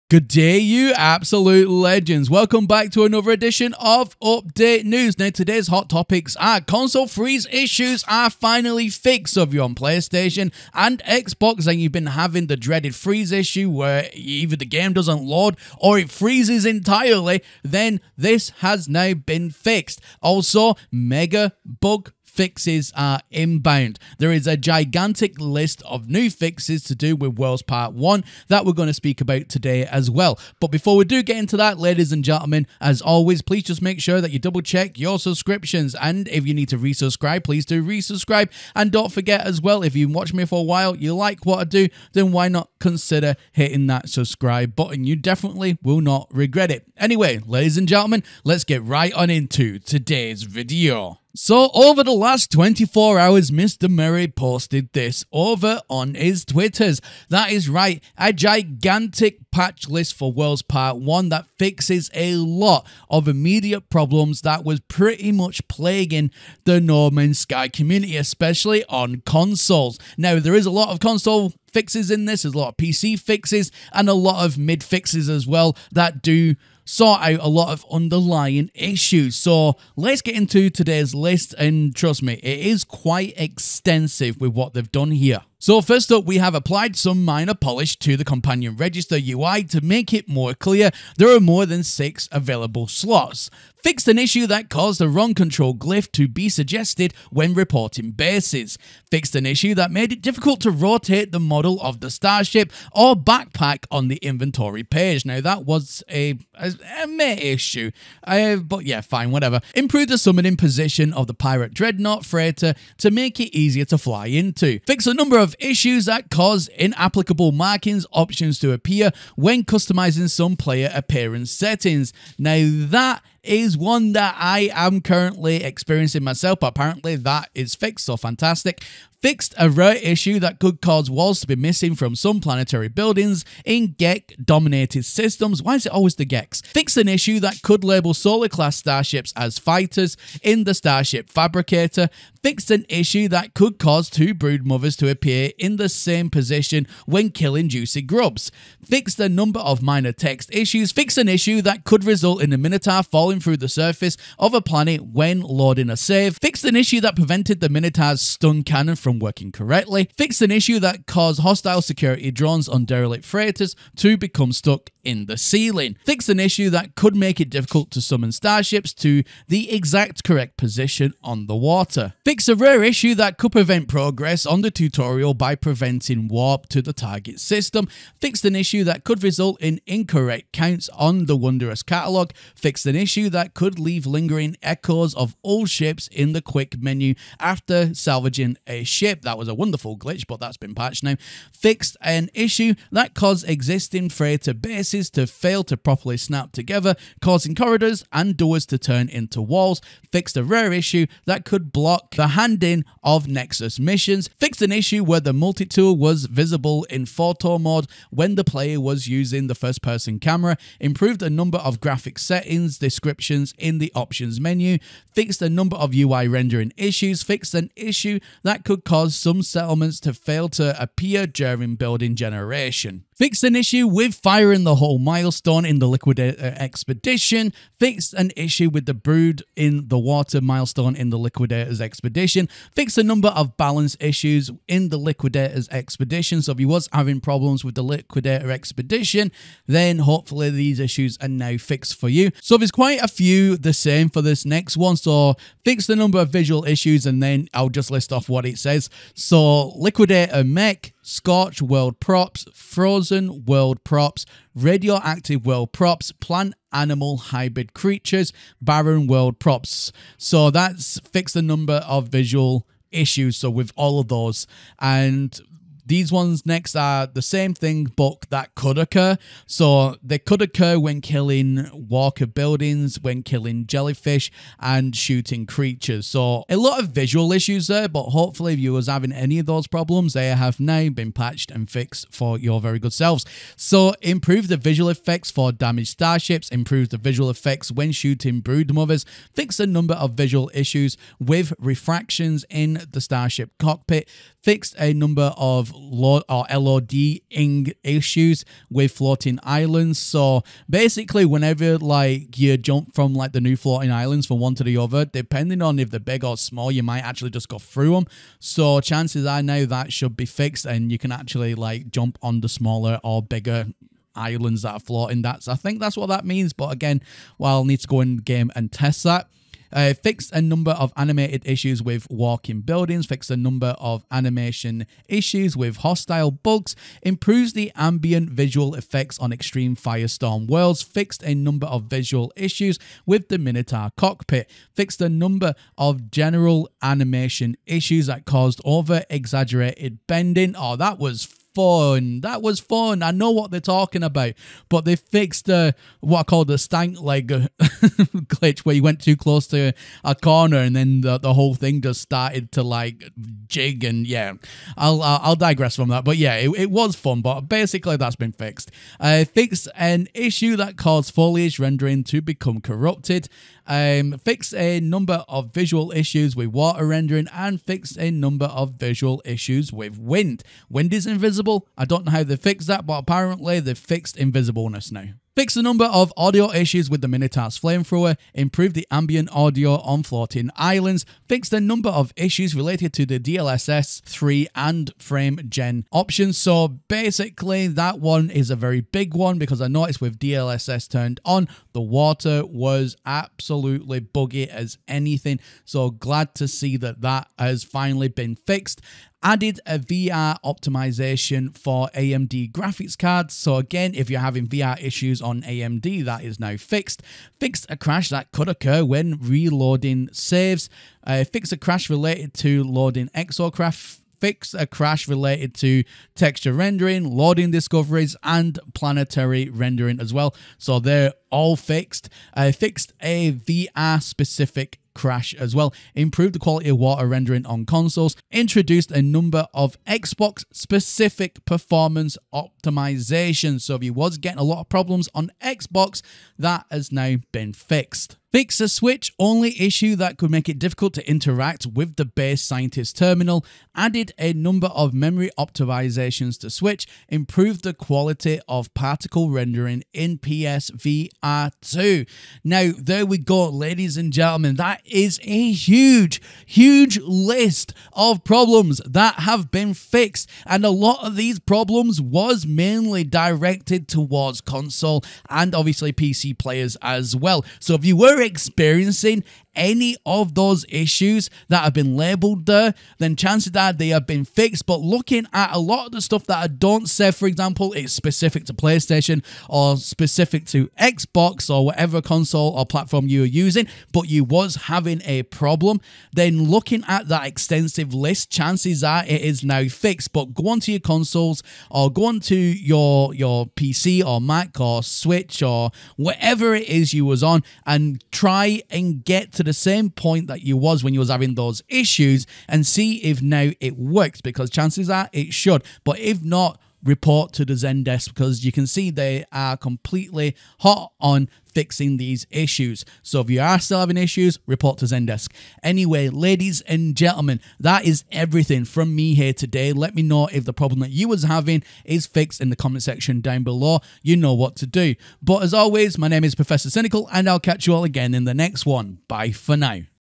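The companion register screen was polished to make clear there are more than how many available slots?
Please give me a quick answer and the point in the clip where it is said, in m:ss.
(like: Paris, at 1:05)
6, at 1:31.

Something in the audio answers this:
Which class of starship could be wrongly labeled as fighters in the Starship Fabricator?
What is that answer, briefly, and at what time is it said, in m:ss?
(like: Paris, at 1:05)
Solar, at 2:18.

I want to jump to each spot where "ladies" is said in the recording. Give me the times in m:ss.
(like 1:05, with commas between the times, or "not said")
0:31, 0:47, 7:33, 8:36.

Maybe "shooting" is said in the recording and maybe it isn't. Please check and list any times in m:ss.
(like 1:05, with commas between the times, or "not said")
4:34, 4:47.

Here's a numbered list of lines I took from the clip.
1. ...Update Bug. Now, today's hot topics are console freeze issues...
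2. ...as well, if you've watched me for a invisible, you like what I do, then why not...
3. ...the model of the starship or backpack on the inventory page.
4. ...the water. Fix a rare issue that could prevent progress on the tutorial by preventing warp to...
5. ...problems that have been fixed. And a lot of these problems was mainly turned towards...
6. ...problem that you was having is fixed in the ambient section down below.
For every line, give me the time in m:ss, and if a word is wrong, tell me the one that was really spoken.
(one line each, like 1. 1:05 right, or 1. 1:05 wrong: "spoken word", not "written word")
1. 0:04 wrong: "News", not "Bug"
2. 0:39 wrong: "while", not "invisible"
3. 1:41 right
4. 2:51 right
5. 7:38 wrong: "directed", not "turned"
6. 8:40 wrong: "comment", not "ambient".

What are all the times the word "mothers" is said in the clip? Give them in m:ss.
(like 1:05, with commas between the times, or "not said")
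2:24, 4:48.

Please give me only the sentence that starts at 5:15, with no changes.
That's I think that's what that means.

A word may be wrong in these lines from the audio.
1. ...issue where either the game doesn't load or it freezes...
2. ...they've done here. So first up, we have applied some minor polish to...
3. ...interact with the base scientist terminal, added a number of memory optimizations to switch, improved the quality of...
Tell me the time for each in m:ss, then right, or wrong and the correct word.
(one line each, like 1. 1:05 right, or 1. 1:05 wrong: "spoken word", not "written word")
1. 0:13 right
2. 1:24 right
3. 7:21 right.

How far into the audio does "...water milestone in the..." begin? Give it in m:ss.
3:49.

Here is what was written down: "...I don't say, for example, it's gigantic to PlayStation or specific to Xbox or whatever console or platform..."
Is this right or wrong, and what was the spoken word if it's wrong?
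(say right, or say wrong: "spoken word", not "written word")
wrong: "specific", not "gigantic".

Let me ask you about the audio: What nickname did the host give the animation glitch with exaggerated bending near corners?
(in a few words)
stank leg.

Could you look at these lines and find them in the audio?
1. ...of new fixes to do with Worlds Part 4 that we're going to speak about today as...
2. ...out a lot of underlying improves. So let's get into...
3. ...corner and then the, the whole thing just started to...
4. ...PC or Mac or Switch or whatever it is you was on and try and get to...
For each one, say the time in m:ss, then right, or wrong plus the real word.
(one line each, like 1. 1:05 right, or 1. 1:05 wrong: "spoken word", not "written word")
1. 0:25 wrong: "1", not "4"
2. 1:17 wrong: "issues", not "improves"
3. 5:50 right
4. 8:13 right.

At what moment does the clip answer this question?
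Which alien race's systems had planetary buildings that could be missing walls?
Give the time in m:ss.
2:13.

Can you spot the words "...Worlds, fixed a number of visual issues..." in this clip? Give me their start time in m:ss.
5:30.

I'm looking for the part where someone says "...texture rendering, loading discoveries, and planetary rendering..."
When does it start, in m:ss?
6:56.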